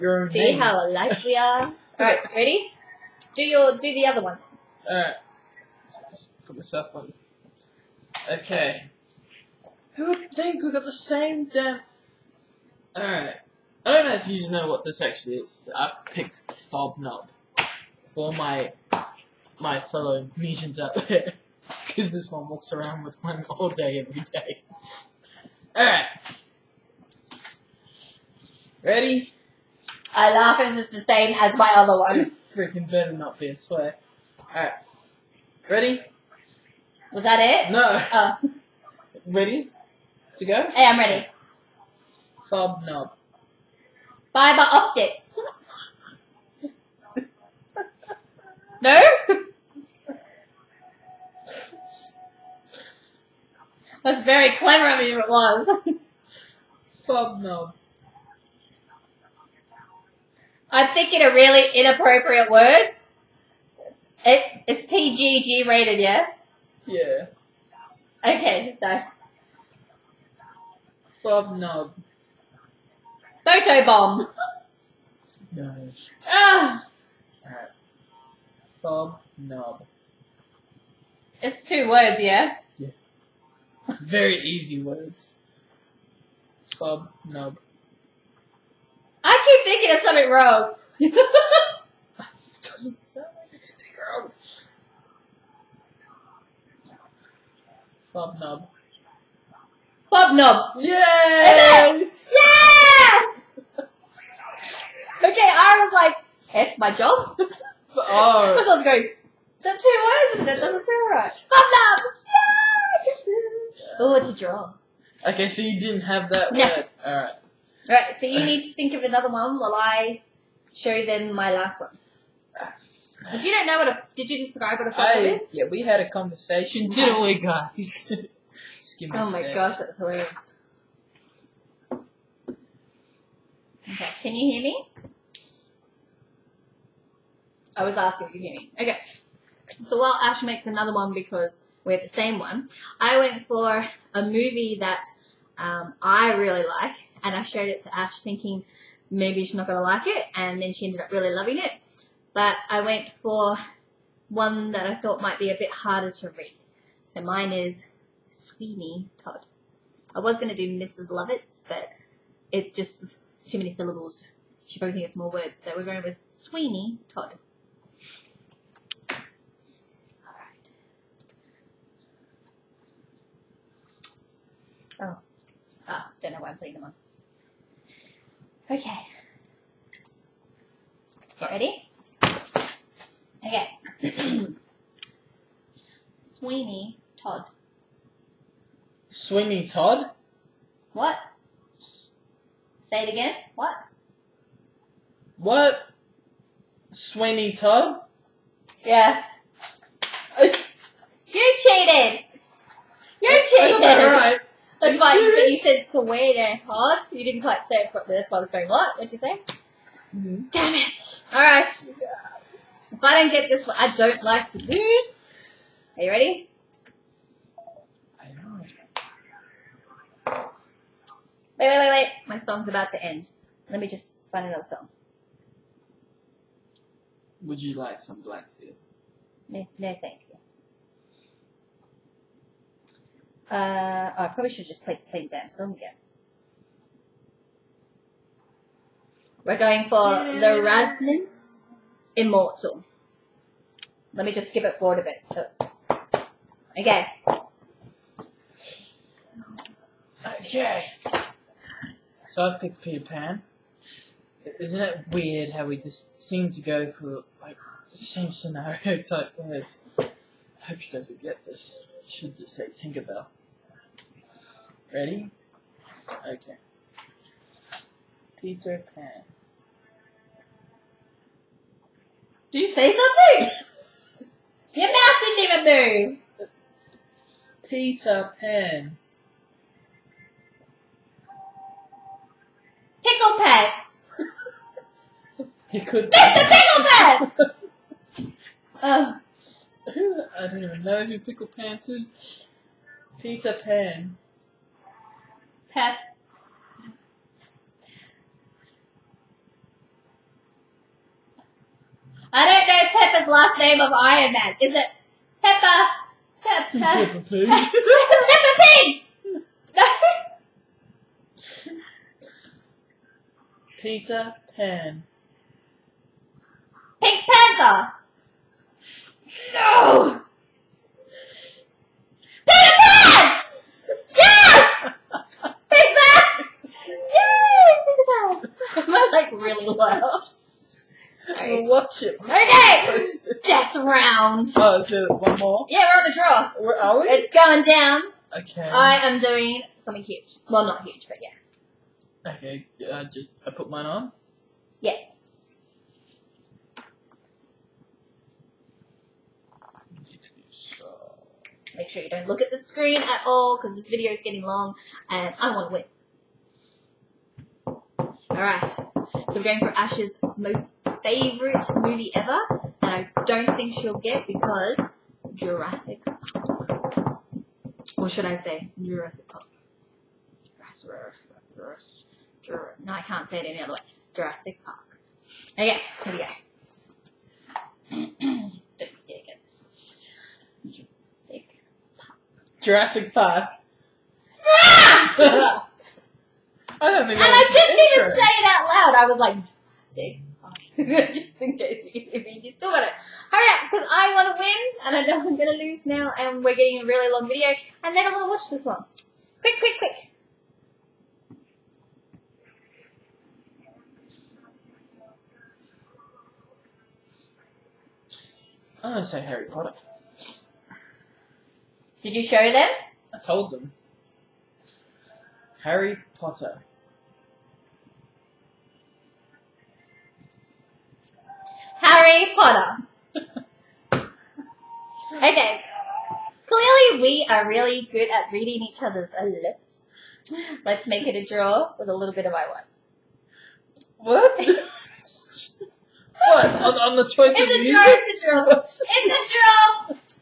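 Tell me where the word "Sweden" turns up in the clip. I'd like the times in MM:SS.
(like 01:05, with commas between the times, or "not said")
03:25.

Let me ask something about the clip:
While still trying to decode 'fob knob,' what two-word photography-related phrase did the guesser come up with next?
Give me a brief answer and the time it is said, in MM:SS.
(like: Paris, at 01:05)
Photo bomb, at 01:13.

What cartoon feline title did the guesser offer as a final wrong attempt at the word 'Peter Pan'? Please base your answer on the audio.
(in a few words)
Pink Panther.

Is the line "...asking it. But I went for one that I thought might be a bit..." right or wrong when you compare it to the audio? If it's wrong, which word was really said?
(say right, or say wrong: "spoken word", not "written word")
wrong: "loving", not "asking".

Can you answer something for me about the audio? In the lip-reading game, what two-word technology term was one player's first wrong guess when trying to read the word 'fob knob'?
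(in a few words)
Fiber optic.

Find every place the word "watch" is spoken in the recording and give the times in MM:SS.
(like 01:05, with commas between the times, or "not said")
05:31, 06:38.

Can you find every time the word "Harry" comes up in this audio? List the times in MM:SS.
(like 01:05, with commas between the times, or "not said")
06:49, 06:55, 07:02.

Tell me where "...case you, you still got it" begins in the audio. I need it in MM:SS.
06:31.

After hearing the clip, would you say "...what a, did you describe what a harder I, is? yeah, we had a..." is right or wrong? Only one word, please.
wrong.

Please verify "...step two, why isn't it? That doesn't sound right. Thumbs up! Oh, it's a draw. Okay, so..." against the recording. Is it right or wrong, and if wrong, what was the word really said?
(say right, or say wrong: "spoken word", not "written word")
right.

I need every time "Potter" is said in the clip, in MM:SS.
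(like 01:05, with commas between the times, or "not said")
06:49, 06:56, 07:02.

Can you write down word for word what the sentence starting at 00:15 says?
I picked Fob Knob all my my fellow Grecians out there.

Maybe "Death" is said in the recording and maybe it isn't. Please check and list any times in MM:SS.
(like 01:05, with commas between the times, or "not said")
05:33.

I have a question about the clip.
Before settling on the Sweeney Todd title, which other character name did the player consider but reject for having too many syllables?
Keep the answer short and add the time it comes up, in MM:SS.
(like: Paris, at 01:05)
Mrs. Lovitz, at 02:40.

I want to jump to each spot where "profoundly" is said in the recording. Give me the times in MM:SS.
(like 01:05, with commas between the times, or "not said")
not said.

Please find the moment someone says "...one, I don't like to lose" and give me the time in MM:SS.
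03:33.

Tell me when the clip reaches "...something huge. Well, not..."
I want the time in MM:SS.
05:39.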